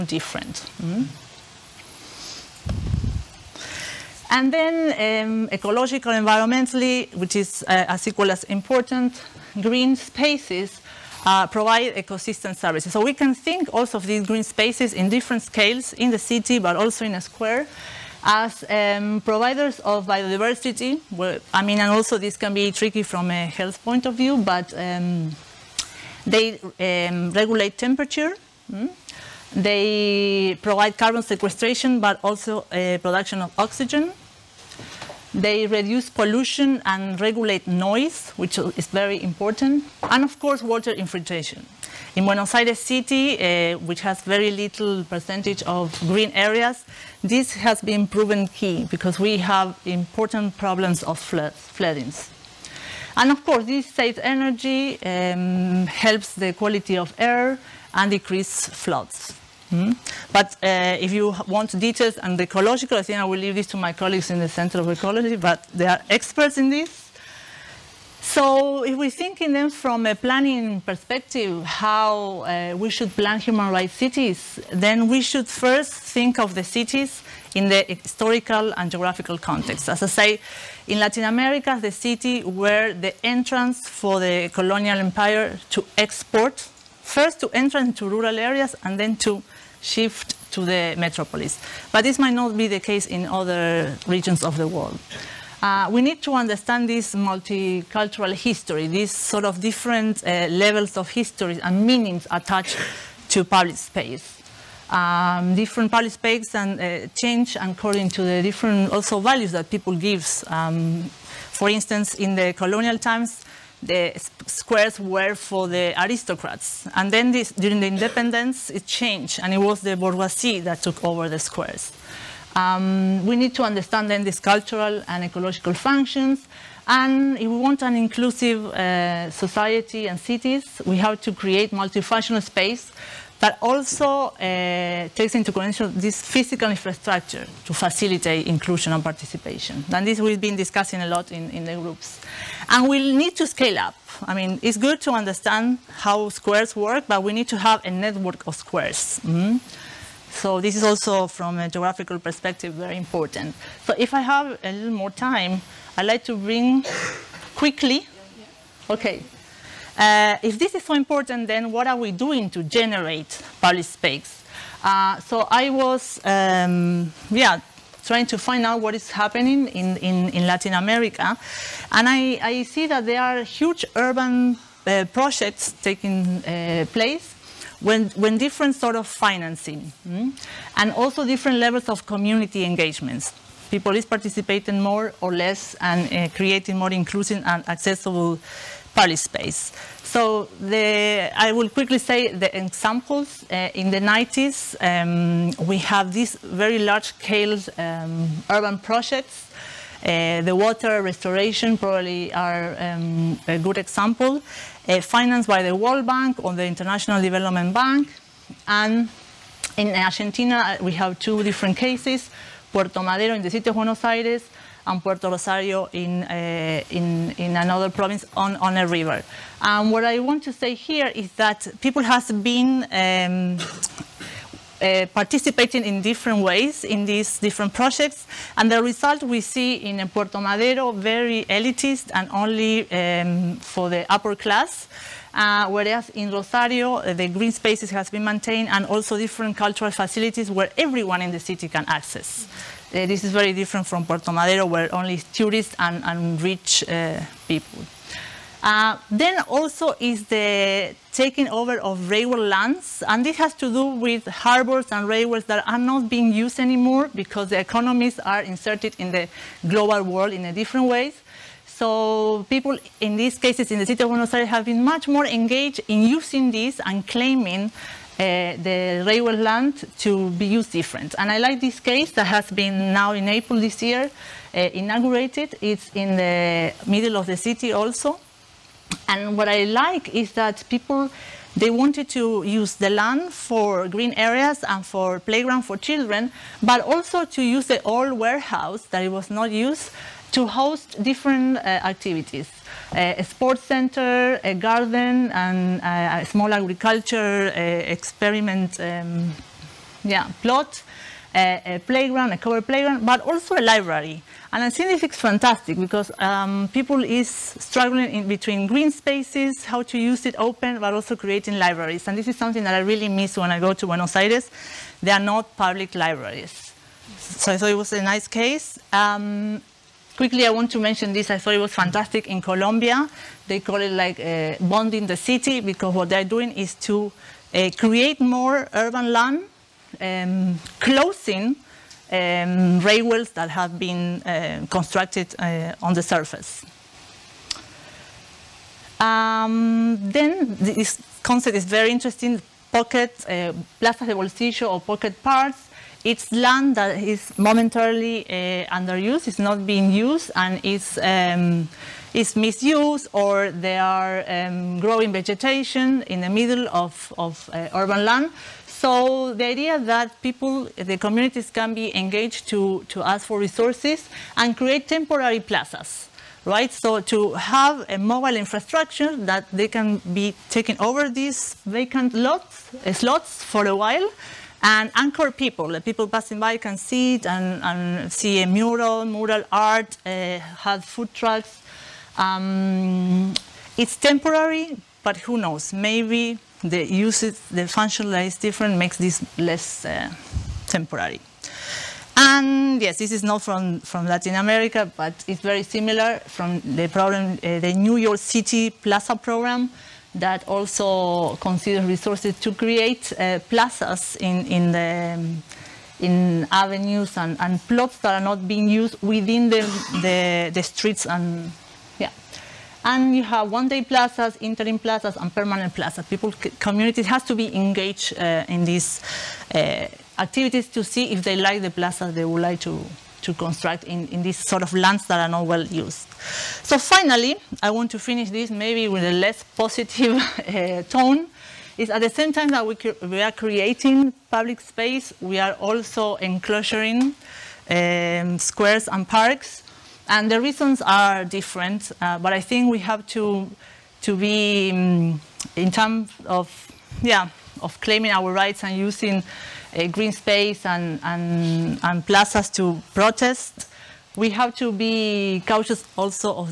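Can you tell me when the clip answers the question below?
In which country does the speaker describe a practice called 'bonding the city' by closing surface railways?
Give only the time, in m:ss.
5:22.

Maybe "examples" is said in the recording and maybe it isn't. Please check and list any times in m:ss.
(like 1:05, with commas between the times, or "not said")
3:12, 3:23.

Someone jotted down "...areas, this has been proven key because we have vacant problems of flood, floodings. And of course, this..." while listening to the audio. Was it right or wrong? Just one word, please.
wrong.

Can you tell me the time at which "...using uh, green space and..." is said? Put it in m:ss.
7:28.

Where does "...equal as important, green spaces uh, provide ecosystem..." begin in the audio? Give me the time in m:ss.
0:08.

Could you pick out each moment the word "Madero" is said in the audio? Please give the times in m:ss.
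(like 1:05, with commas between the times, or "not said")
3:33, 3:50, 4:04.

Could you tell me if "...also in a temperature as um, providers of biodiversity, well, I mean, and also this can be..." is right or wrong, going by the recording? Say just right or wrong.
wrong.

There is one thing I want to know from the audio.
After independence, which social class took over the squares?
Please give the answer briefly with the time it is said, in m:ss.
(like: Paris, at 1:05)
the bourgeoisie, at 1:59.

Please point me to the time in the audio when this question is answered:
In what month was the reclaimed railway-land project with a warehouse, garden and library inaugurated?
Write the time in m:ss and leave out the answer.
4:33.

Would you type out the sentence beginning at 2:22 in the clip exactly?
And we we'll need to scale up.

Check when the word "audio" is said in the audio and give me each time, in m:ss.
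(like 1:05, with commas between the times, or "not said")
not said.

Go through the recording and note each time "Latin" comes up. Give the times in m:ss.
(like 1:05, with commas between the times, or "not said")
1:20, 2:50, 6:34.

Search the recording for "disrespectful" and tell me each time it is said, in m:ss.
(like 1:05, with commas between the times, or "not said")
not said.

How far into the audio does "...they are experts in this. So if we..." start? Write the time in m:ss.
1:05.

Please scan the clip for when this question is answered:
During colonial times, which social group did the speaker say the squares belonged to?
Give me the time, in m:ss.
1:55.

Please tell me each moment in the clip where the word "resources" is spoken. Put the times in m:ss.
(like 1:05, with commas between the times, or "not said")
6:03, 6:41.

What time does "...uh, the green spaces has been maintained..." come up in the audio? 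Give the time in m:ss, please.
3:56.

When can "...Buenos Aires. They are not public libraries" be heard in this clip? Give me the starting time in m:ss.
5:13.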